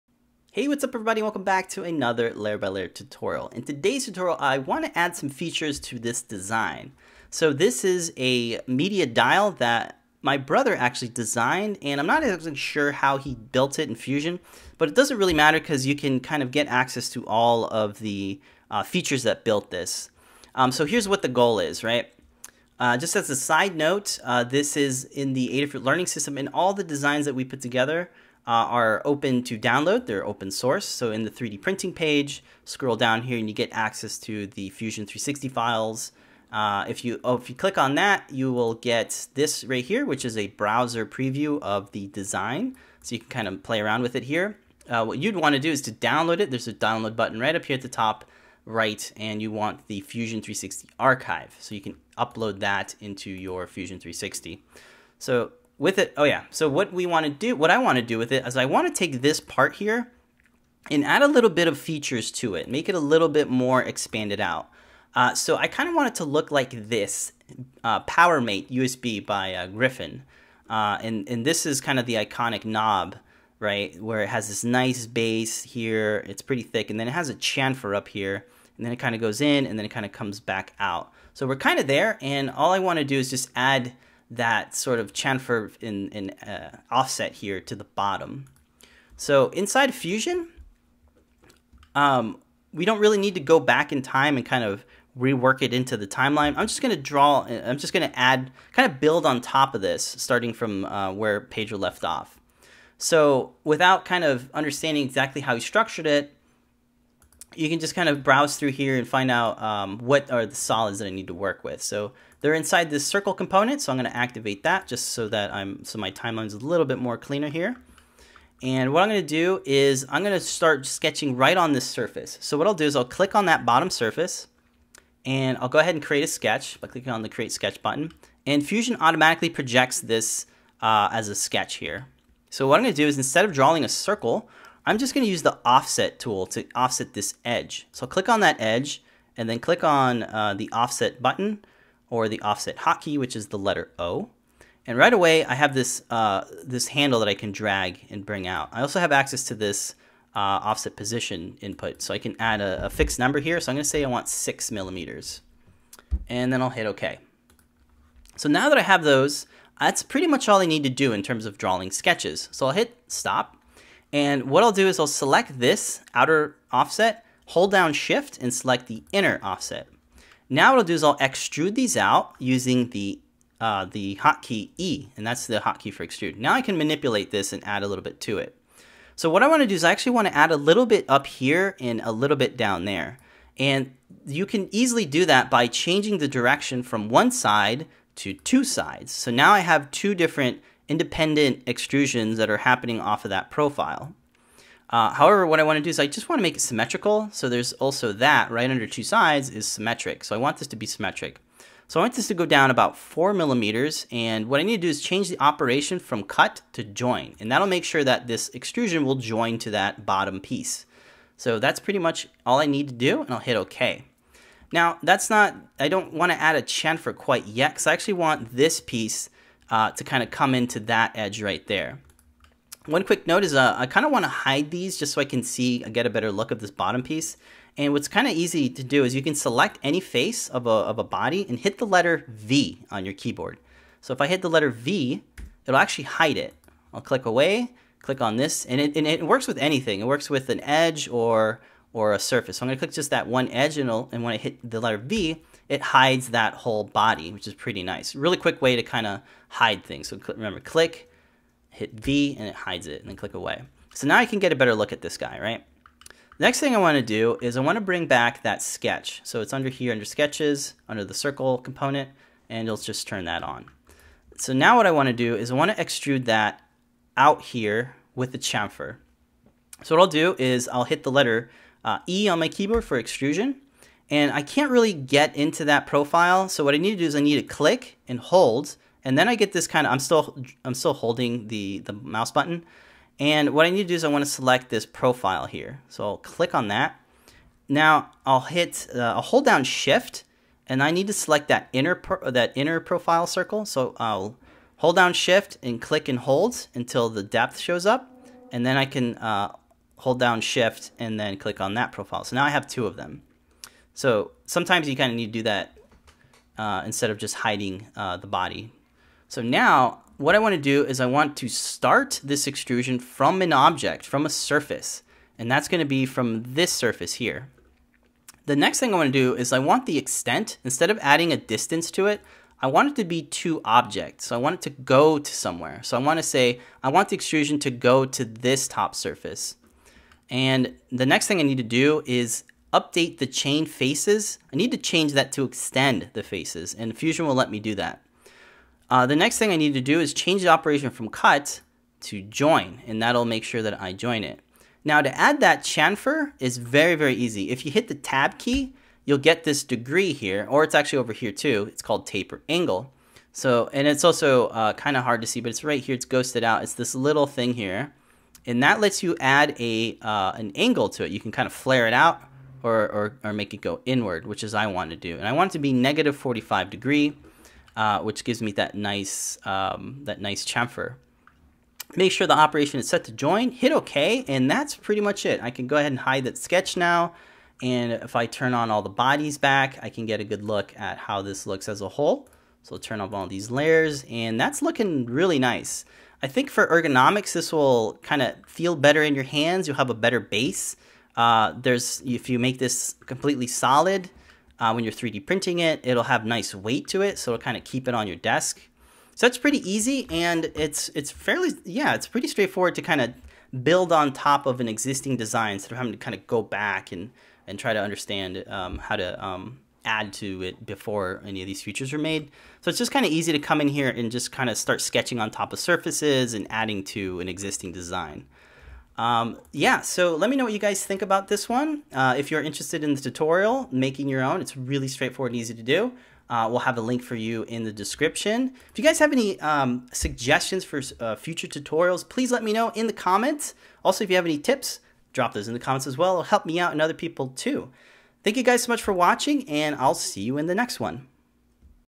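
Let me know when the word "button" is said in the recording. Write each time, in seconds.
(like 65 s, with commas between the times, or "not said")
47 s, 127 s, 141 s, 282 s.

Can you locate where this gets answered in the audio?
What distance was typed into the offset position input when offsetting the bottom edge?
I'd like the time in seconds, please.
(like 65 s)
154 s.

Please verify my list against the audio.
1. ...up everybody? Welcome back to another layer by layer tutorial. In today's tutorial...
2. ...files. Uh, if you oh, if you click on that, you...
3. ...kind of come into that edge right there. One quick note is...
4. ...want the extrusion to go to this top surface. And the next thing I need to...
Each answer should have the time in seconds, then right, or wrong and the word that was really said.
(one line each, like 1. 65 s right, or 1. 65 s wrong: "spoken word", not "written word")
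1. 0 s right
2. 35 s right
3. 220 s right
4. 326 s right.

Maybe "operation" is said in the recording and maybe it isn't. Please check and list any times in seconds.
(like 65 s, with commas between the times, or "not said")
205 s, 340 s, 372 s.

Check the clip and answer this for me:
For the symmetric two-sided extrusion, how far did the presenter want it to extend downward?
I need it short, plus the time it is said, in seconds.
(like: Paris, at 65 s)
4 millimeters, at 202 s.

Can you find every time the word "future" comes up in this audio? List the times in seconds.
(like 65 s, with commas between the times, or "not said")
431 s.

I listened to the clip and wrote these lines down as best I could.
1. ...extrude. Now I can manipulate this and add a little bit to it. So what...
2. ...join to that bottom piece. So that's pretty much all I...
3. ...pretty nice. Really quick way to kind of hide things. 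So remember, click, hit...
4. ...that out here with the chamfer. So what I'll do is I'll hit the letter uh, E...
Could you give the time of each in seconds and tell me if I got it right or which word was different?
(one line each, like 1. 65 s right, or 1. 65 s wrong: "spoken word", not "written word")
1. 176 s right
2. 209 s right
3. 247 s right
4. 266 s right.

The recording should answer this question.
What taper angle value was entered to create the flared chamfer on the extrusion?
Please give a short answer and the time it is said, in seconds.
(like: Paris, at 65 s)
-45 degrees, at 365 s.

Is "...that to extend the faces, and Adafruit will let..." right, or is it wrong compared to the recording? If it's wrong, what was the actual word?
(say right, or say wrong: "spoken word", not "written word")
wrong: "Fusion", not "Adafruit".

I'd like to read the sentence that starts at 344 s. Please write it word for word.
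Now to add that chamfer is very, very easy.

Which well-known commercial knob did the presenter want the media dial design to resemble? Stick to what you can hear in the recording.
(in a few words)
PowerMate USB.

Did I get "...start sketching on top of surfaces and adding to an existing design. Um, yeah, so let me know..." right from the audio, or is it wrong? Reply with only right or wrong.
right.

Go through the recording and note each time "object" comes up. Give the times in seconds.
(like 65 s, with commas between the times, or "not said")
313 s, 323 s.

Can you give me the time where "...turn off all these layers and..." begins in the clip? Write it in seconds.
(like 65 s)
382 s.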